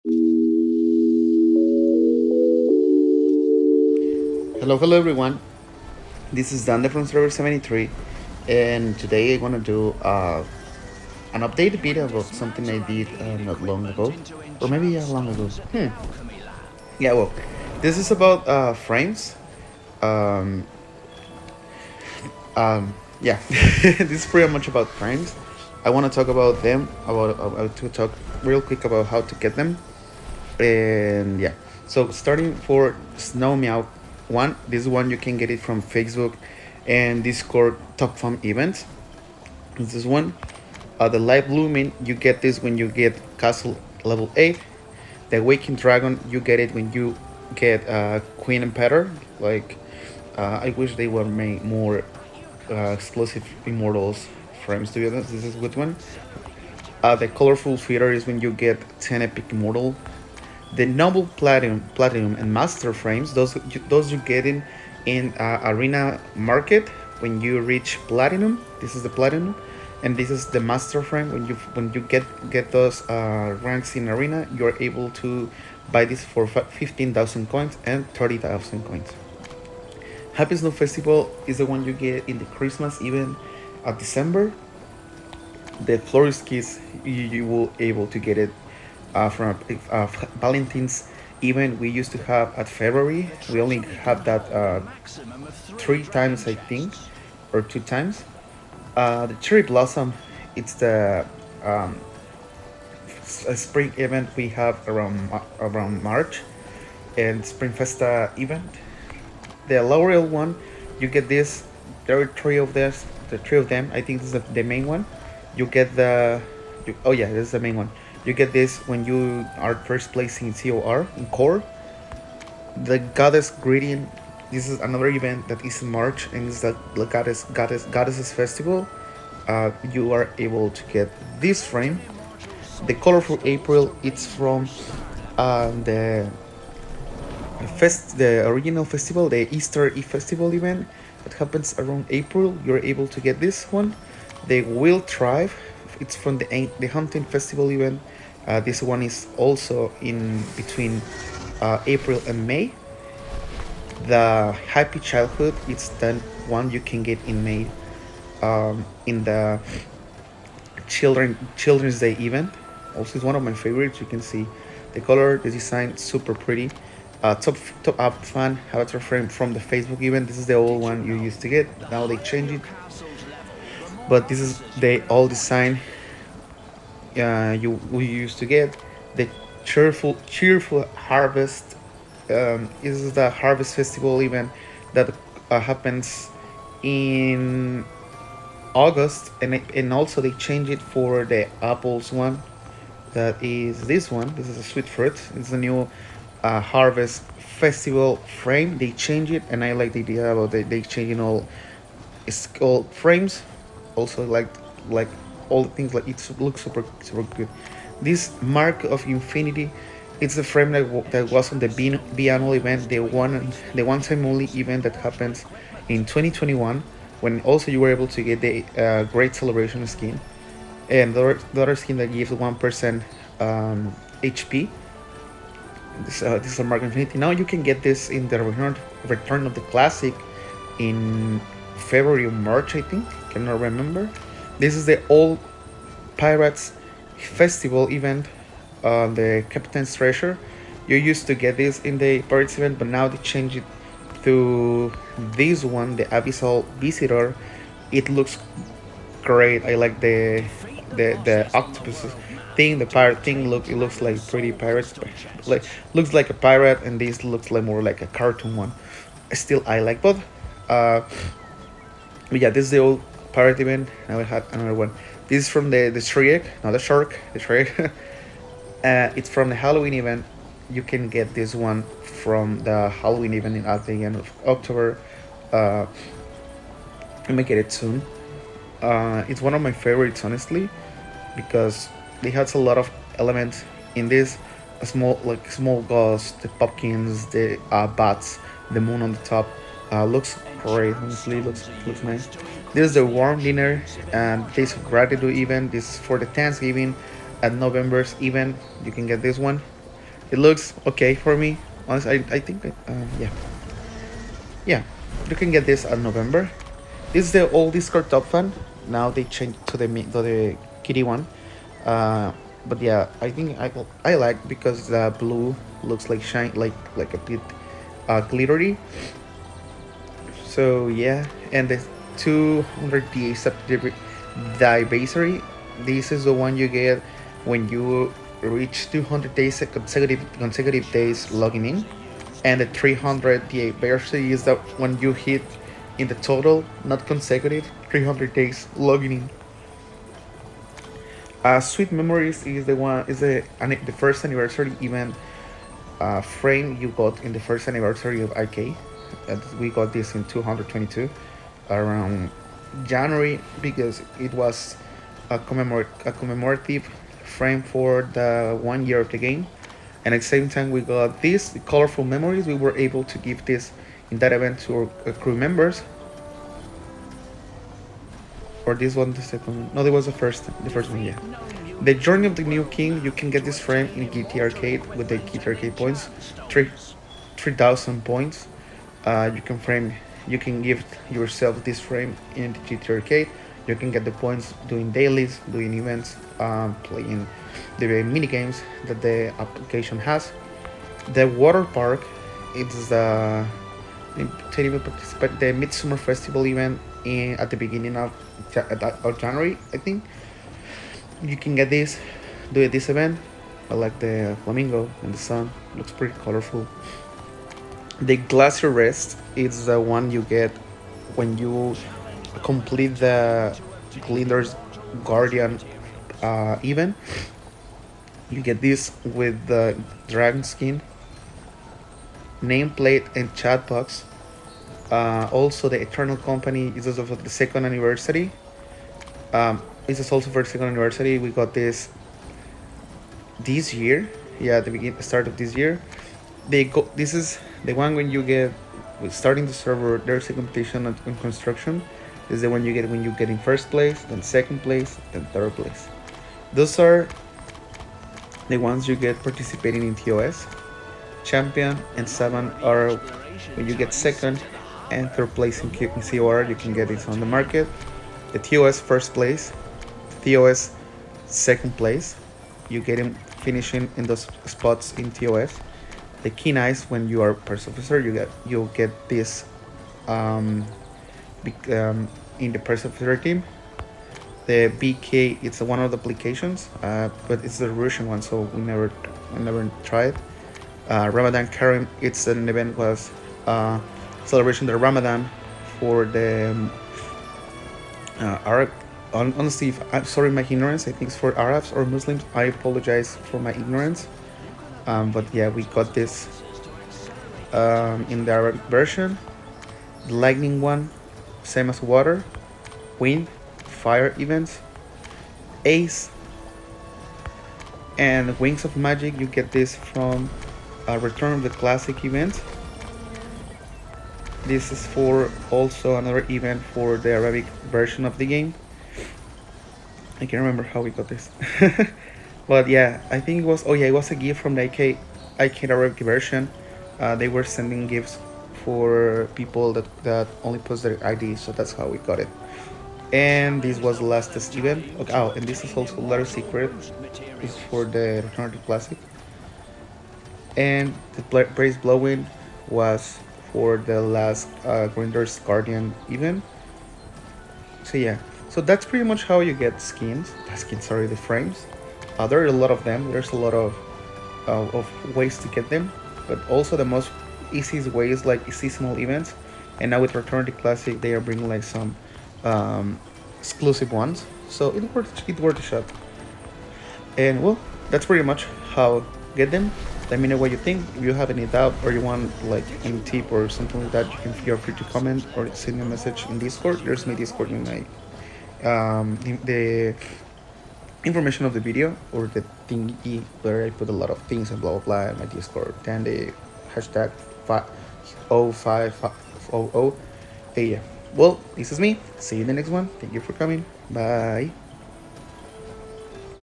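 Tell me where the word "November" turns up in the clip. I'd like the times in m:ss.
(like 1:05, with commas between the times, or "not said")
4:57, 5:05.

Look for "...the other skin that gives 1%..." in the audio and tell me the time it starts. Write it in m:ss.
3:41.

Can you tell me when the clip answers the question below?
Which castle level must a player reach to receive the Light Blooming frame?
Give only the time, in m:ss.
0:43.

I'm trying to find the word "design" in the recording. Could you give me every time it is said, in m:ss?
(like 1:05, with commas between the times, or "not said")
2:45, 2:55.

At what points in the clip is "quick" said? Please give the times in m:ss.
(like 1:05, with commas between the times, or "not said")
0:28.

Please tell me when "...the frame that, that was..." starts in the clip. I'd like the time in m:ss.
3:30.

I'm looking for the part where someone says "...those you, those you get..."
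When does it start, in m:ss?
1:03.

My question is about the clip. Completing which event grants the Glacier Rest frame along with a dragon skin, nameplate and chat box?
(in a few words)
Glinder's Guardian.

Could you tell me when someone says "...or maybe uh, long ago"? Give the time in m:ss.
0:14.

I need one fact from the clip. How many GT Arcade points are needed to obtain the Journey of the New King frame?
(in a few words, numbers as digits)
3000.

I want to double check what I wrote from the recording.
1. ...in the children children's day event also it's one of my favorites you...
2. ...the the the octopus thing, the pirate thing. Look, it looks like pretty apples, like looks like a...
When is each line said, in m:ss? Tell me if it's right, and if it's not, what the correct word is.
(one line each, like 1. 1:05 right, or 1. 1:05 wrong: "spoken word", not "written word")
1. 2:39 right
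2. 4:09 wrong: "pirates", not "apples".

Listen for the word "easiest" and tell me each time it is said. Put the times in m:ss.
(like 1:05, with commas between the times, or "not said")
9:17.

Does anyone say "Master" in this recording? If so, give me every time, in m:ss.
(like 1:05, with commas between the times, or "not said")
1:02, 1:10.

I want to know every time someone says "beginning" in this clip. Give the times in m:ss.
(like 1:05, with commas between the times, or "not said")
6:37, 7:14.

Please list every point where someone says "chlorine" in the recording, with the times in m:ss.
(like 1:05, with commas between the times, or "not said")
not said.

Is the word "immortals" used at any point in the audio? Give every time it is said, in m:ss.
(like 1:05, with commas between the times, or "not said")
0:53, 0:59.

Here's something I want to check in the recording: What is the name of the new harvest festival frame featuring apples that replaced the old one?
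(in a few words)
Sweet Fruit.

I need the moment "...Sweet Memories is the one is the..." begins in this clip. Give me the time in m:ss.
5:41.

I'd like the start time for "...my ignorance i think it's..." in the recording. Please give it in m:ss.
8:10.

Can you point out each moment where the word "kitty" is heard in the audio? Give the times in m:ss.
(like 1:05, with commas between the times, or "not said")
5:10.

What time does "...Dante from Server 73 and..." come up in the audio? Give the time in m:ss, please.
0:06.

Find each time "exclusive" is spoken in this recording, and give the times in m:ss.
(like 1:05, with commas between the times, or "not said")
0:52, 9:23.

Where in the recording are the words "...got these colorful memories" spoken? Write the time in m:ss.
6:00.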